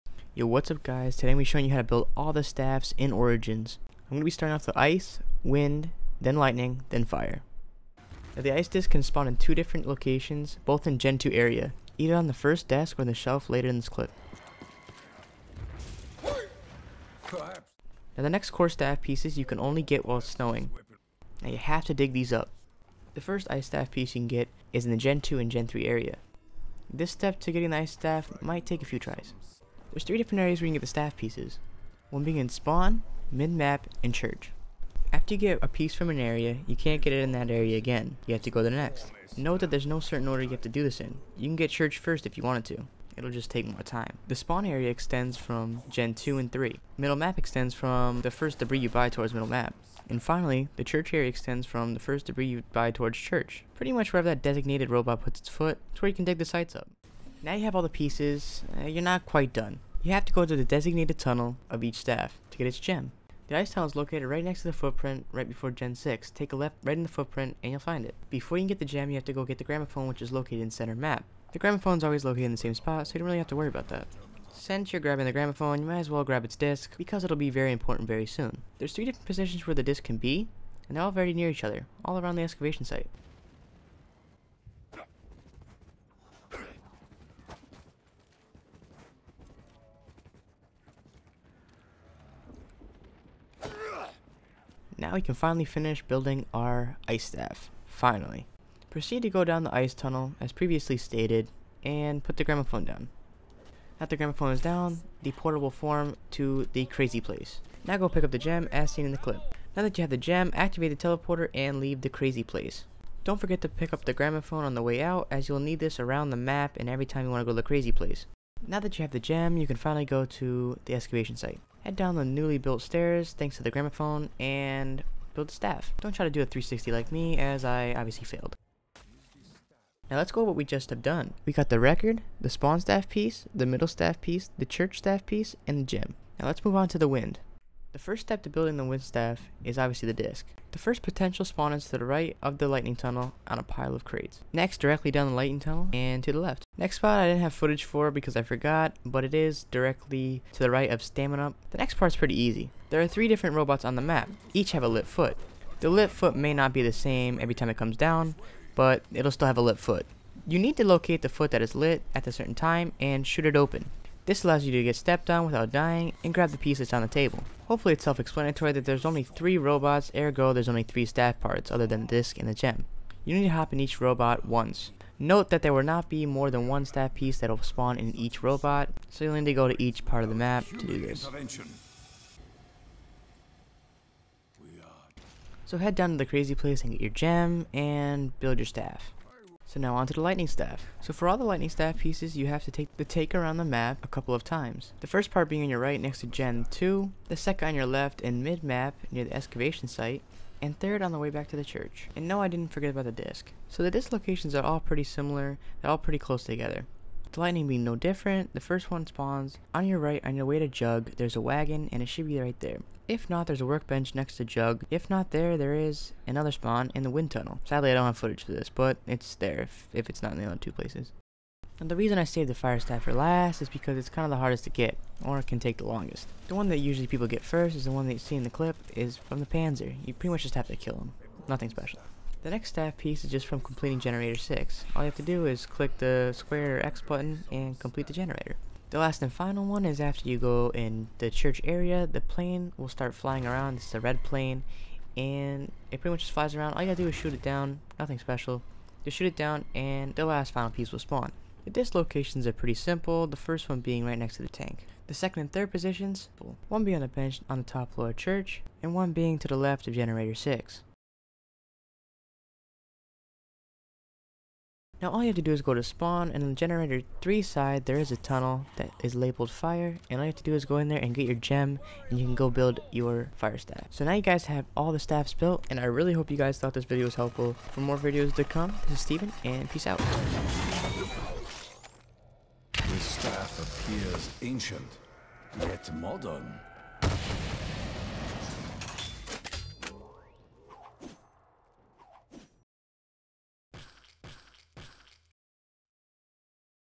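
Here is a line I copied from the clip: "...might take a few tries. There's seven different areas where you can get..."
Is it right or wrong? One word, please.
wrong.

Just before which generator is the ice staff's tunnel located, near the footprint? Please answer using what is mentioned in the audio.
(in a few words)
Gen 6.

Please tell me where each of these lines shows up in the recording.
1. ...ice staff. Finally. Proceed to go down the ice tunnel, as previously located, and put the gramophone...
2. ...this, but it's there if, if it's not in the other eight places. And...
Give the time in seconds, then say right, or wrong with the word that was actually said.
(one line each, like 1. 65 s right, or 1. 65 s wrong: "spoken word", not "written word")
1. 97 s wrong: "stated", not "located"
2. 218 s wrong: "two", not "eight".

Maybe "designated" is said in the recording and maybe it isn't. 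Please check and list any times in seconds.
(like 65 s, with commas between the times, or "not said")
54 s, 60 s.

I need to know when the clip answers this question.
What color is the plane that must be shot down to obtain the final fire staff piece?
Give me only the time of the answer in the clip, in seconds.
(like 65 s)
243 s.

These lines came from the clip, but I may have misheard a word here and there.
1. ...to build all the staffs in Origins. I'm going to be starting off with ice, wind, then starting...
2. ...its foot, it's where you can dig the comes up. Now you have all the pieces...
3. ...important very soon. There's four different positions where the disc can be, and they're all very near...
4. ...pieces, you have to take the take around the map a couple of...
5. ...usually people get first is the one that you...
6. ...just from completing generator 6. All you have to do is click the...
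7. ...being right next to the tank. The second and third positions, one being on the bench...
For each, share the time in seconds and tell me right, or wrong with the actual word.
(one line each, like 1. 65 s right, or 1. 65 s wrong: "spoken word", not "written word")
1. 1 s wrong: "lightning", not "starting"
2. 55 s wrong: "sites", not "comes"
3. 77 s wrong: "three", not "four"
4. 191 s right
5. 226 s right
6. 233 s right
7. 253 s right.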